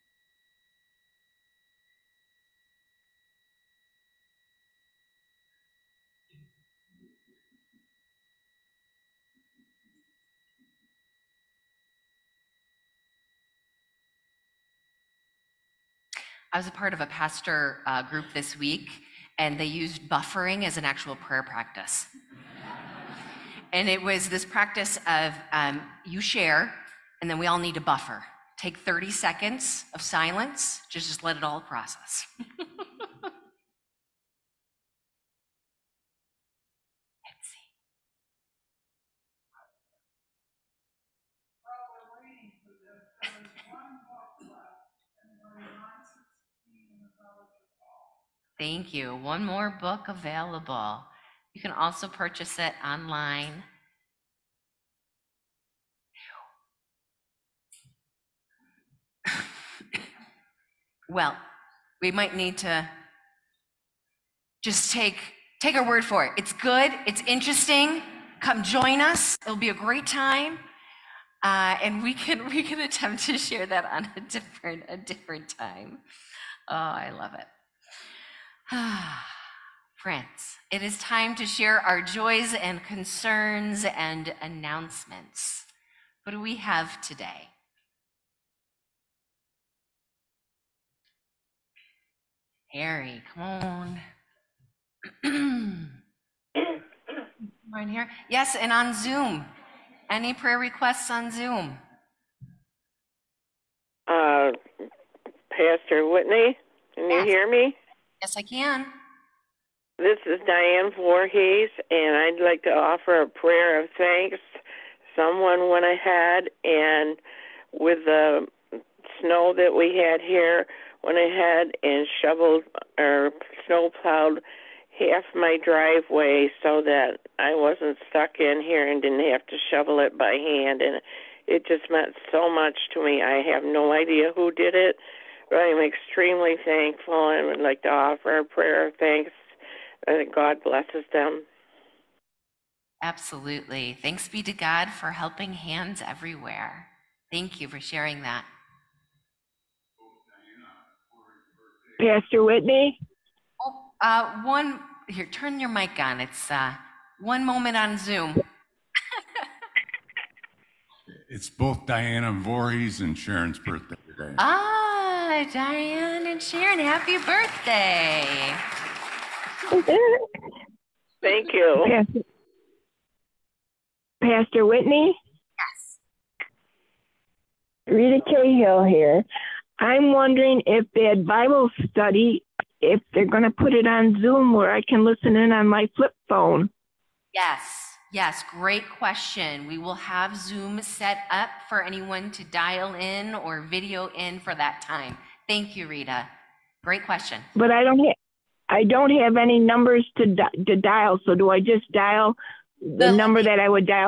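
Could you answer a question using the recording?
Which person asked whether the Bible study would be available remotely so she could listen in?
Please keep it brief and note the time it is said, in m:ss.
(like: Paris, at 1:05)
Rita Cahill, at 2:57.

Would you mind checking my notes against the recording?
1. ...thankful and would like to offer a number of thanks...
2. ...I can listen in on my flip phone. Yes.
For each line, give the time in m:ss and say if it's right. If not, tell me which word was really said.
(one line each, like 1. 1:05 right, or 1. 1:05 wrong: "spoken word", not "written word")
1. 2:16 wrong: "prayer", not "number"
2. 3:04 right.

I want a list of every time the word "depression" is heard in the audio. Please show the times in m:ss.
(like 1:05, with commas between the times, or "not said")
not said.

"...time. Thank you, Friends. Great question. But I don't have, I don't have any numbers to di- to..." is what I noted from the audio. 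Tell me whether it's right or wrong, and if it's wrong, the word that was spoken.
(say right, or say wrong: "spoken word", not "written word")
wrong: "Rita", not "Friends".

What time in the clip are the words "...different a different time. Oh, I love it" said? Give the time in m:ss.
1:14.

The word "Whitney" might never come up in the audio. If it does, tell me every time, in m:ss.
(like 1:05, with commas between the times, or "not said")
1:46, 2:32, 2:54.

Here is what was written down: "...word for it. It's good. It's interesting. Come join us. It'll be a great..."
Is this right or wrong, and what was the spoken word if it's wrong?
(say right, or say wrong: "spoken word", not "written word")
right.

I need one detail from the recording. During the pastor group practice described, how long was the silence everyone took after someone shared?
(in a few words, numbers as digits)
30 seconds.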